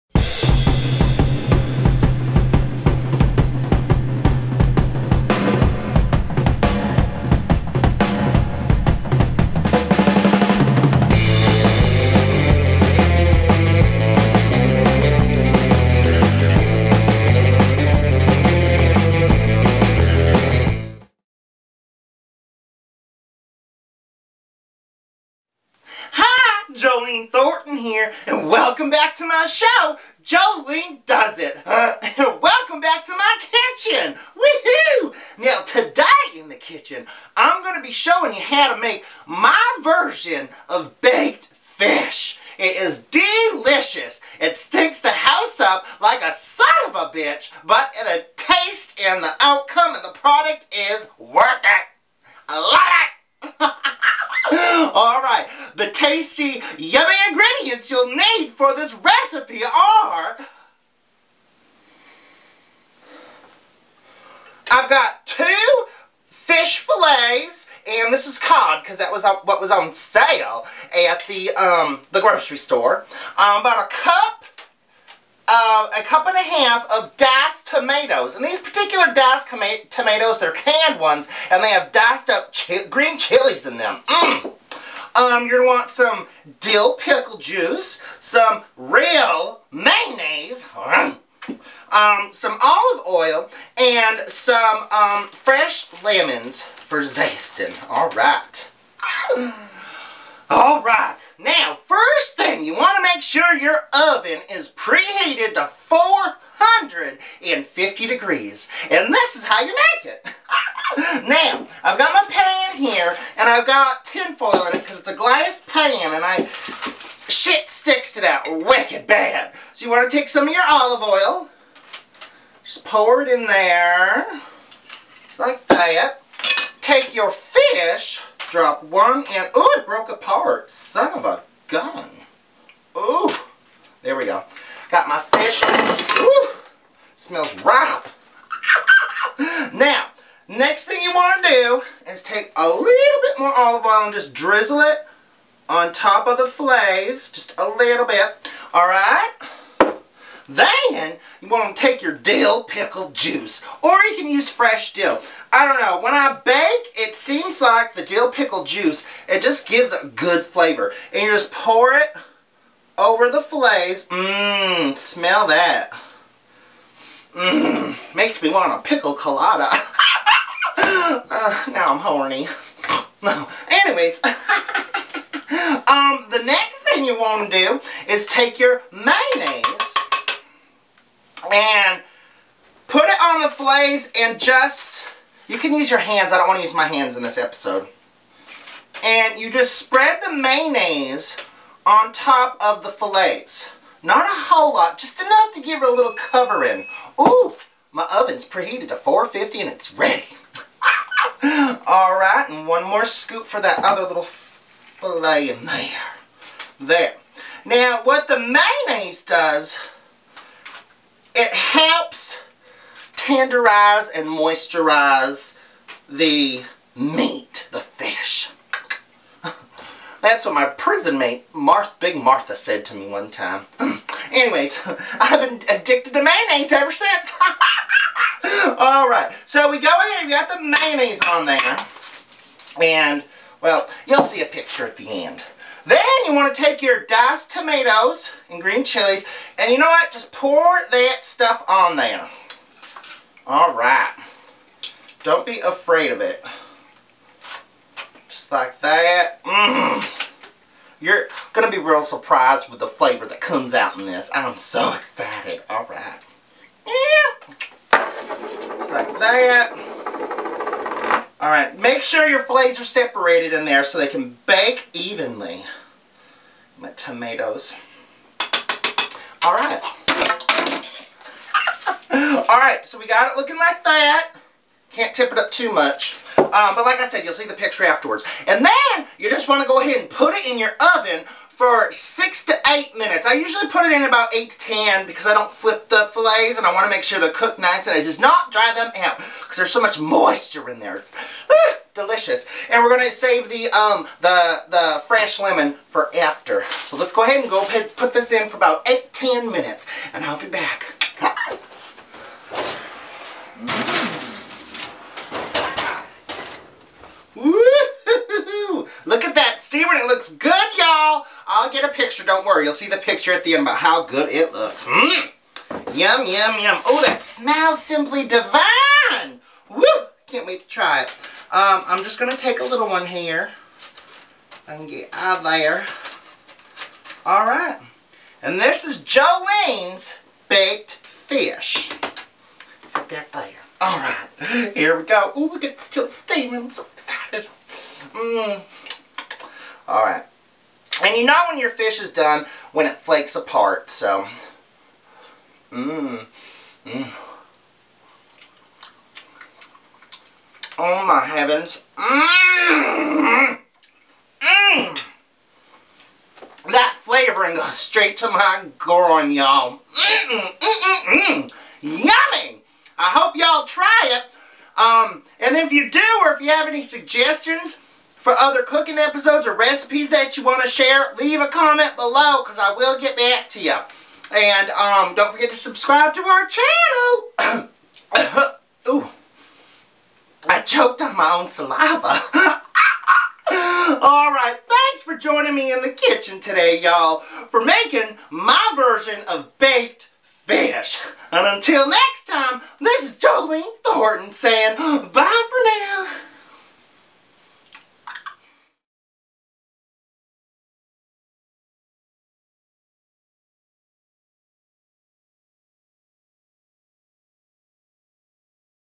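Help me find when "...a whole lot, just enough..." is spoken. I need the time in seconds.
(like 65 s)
194 s.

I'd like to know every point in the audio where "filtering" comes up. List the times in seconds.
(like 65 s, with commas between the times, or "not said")
not said.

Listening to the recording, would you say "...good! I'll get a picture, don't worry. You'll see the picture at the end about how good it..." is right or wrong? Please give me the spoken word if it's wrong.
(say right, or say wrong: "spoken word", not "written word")
right.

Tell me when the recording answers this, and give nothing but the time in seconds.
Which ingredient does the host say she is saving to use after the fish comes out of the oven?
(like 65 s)
295 s.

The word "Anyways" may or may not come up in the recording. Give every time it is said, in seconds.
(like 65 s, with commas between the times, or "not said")
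173 s, 224 s.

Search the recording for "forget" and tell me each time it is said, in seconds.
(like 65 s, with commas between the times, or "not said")
375 s.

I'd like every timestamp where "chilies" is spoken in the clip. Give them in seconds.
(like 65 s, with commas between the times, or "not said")
83 s, 238 s.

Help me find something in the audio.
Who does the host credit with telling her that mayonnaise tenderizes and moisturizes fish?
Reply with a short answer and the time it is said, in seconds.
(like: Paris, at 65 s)
Big Martha, at 221 s.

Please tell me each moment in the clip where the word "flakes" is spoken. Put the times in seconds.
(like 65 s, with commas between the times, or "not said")
342 s.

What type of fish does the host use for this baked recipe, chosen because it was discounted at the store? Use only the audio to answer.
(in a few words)
cod.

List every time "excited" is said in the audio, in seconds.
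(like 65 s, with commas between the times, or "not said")
254 s, 336 s.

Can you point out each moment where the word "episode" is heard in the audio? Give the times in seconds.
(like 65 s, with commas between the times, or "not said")
187 s, 368 s.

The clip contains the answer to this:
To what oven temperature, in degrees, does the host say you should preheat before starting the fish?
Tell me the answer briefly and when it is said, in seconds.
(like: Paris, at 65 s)
450, at 105 s.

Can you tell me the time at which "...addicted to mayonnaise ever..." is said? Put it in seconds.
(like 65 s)
225 s.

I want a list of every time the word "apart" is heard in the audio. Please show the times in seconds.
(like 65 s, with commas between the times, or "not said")
130 s, 343 s.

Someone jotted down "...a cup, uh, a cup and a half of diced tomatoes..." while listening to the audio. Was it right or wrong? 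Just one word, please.
right.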